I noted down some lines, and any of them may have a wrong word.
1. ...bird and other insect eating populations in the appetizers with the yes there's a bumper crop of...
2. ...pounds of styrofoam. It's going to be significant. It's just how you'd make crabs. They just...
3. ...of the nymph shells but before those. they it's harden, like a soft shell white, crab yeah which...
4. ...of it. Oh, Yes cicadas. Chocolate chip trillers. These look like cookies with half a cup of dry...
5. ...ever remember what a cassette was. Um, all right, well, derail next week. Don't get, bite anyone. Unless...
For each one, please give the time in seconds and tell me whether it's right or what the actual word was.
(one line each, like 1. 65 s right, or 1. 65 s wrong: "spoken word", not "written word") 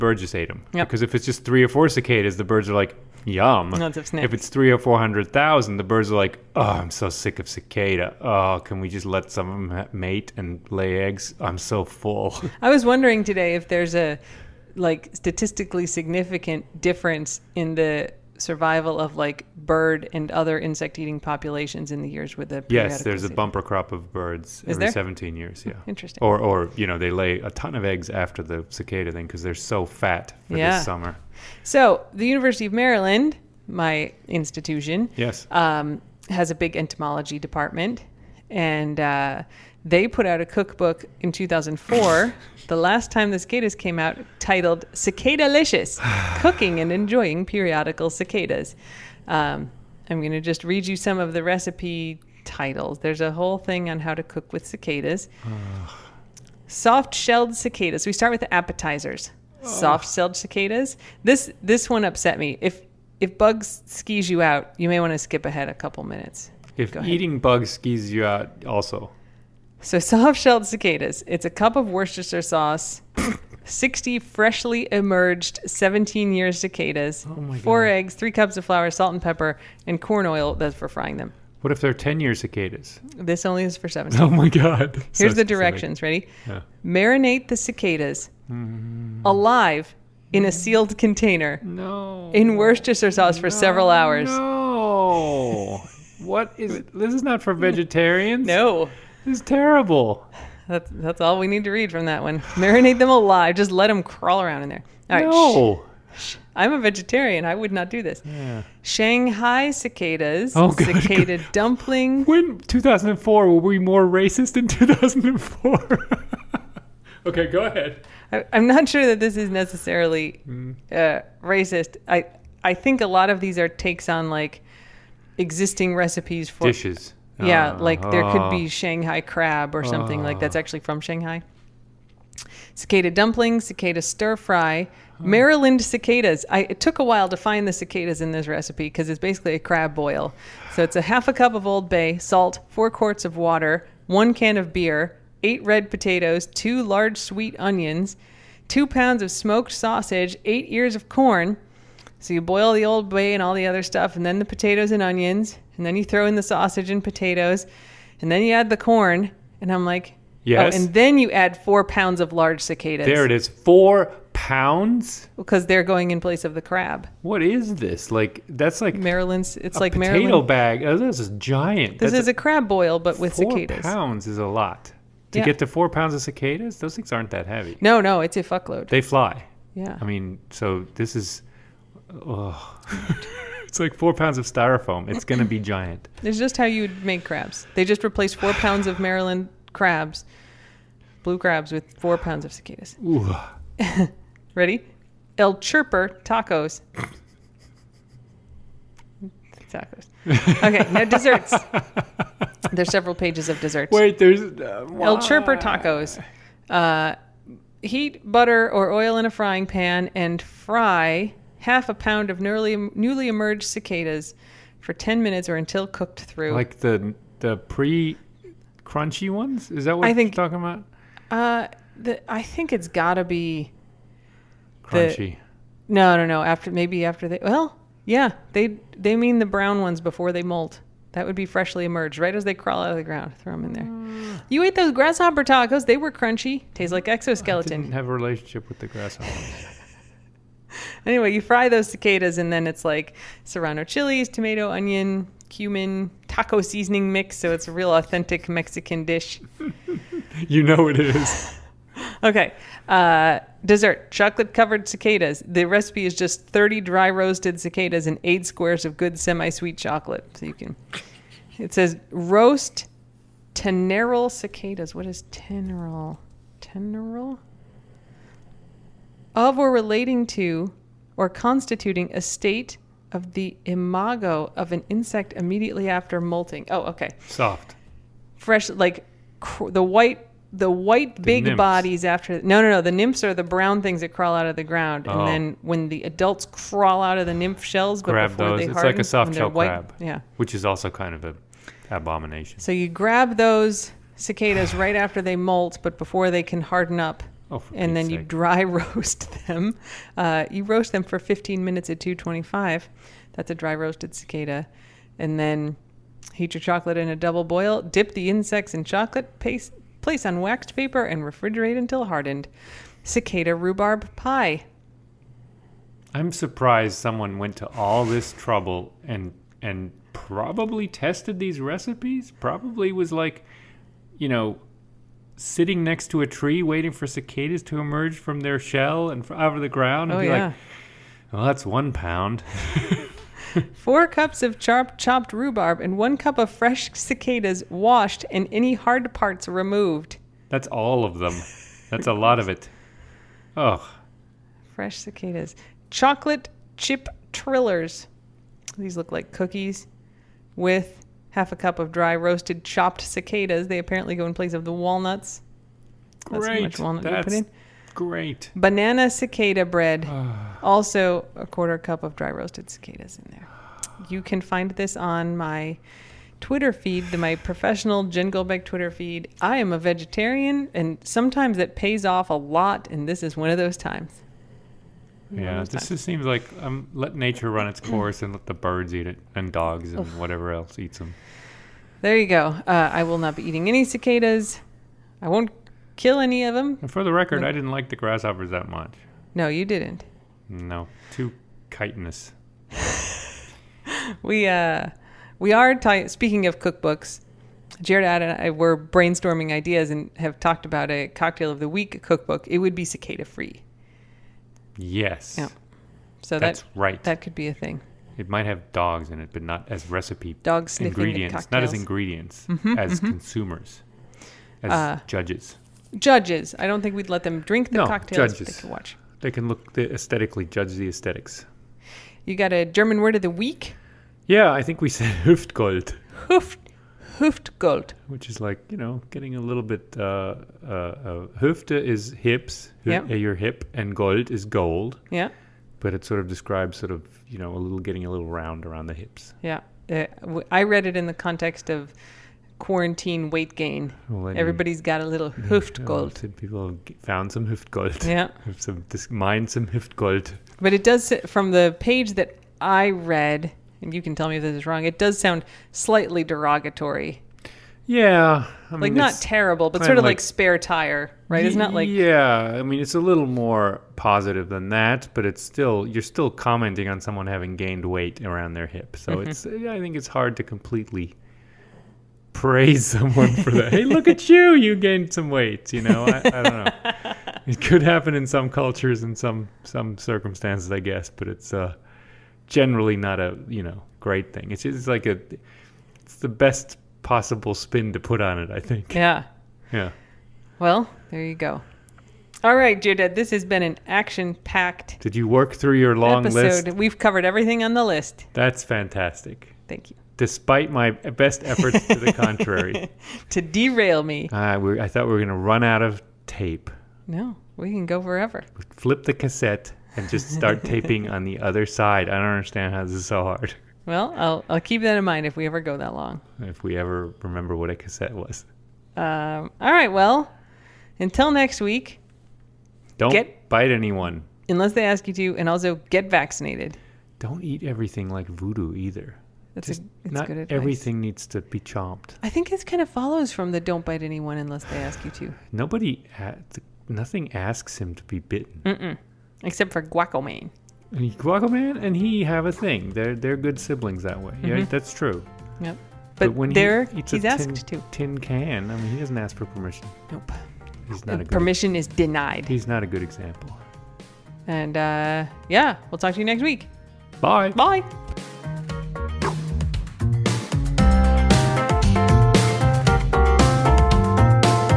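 1. 19 s wrong: "years", not "appetizers"
2. 184 s wrong: "giant", not "significant"
3. 287 s right
4. 342 s wrong: "Fresh", not "Yes"
5. 516 s wrong: "until", not "derail".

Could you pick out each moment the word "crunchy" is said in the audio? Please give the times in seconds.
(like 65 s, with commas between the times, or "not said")
218 s, 224 s, 236 s.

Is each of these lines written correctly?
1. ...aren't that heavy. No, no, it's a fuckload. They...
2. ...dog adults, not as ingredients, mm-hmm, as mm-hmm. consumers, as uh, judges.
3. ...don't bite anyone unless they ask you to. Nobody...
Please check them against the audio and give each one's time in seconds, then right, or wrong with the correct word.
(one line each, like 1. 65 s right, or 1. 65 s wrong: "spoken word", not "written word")
1. 177 s right
2. 410 s wrong: "ingredients", not "adults"
3. 533 s right.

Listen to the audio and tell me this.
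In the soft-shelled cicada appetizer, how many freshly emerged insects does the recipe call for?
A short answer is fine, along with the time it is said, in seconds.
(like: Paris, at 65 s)
60, at 73 s.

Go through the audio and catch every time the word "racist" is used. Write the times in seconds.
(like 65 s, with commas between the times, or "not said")
114 s, 121 s.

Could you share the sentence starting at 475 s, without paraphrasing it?
You know, I, I don't know.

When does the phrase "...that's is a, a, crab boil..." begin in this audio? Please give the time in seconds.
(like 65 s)
172 s.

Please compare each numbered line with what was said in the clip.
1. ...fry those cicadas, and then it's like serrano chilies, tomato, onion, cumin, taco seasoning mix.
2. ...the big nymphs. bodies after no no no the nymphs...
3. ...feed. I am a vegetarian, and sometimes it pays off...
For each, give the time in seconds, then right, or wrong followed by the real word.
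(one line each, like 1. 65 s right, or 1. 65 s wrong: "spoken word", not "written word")
1. 241 s right
2. 281 s right
3. 368 s right.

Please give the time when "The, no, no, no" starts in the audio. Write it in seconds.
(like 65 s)
225 s.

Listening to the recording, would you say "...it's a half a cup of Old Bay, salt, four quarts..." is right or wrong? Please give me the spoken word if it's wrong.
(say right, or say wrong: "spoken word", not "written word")
right.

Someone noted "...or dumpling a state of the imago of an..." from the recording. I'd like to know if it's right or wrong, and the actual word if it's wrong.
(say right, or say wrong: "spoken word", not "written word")
wrong: "constituting", not "dumpling".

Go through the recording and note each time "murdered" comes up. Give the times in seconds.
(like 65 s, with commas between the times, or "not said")
not said.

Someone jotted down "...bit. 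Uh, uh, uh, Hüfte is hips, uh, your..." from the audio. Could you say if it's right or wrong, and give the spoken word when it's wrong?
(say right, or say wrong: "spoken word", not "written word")
right.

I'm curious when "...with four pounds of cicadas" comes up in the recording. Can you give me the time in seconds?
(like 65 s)
191 s.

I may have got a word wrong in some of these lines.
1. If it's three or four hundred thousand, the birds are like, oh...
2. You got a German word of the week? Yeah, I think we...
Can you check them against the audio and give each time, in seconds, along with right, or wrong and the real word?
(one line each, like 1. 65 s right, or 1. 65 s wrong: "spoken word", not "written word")
1. 4 s right
2. 422 s right.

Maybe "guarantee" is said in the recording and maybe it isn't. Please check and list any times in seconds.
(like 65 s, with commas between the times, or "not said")
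not said.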